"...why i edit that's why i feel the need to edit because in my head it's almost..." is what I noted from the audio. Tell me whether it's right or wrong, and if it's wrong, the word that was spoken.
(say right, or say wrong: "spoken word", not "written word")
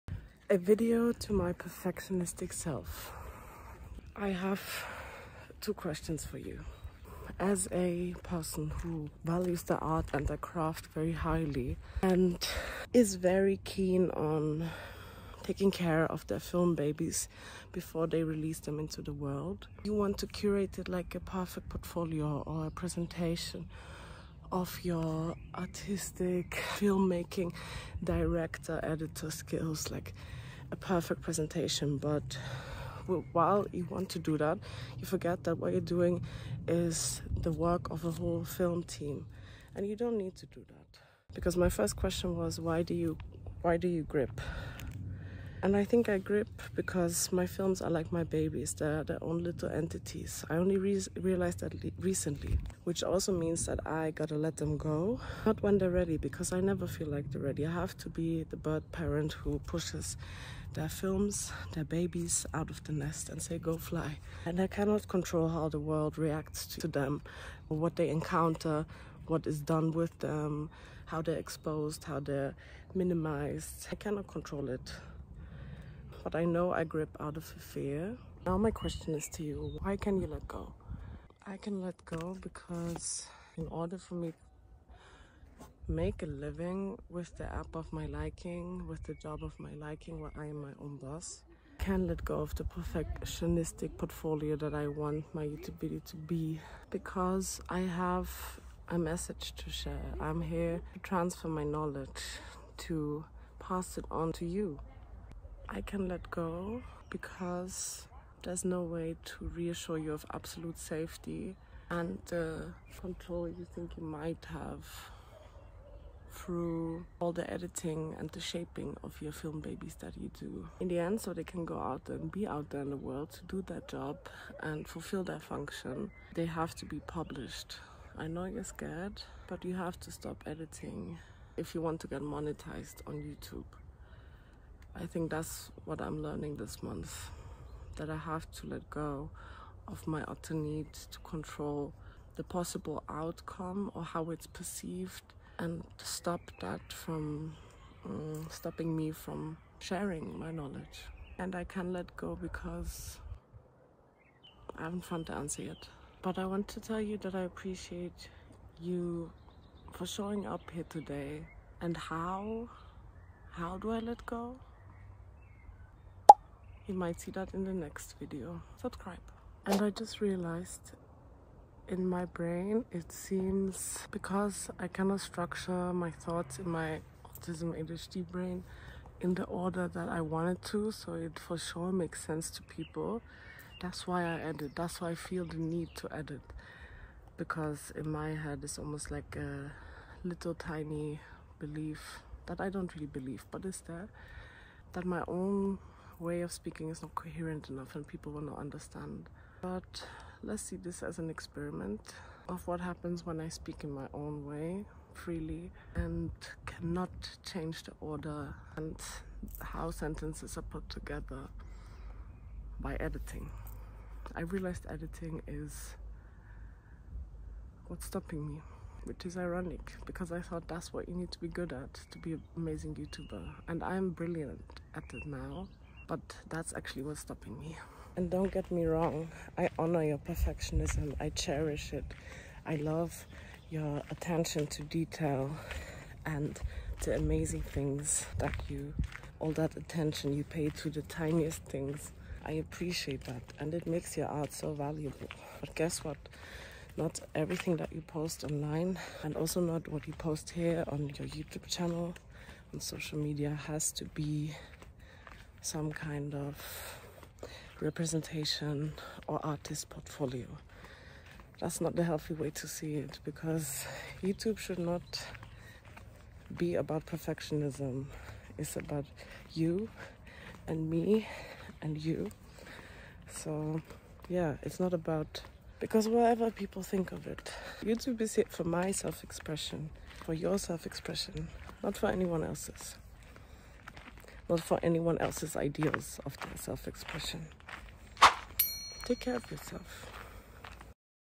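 right.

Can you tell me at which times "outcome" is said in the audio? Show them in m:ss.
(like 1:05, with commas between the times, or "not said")
2:23.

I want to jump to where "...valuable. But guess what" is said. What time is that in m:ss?
4:04.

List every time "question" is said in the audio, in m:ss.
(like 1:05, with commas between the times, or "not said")
0:05, 0:41, 1:18.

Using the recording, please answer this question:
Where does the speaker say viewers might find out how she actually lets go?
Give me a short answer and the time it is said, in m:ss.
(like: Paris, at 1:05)
the next video, at 2:47.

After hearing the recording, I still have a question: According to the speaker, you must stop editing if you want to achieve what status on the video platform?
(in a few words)
monetized.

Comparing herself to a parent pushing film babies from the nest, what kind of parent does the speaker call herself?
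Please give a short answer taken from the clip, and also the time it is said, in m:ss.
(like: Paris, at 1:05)
bird parent, at 0:58.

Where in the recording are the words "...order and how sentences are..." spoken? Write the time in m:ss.
3:27.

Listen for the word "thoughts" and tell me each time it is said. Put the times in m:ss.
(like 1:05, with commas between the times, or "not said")
2:56, 3:40.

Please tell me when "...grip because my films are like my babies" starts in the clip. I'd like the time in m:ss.
0:46.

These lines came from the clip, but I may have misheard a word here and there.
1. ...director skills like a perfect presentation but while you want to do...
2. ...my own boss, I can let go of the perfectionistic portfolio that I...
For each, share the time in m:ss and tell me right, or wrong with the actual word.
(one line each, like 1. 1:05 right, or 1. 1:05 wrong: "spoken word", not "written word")
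1. 0:28 wrong: "editor", not "director"
2. 1:30 right.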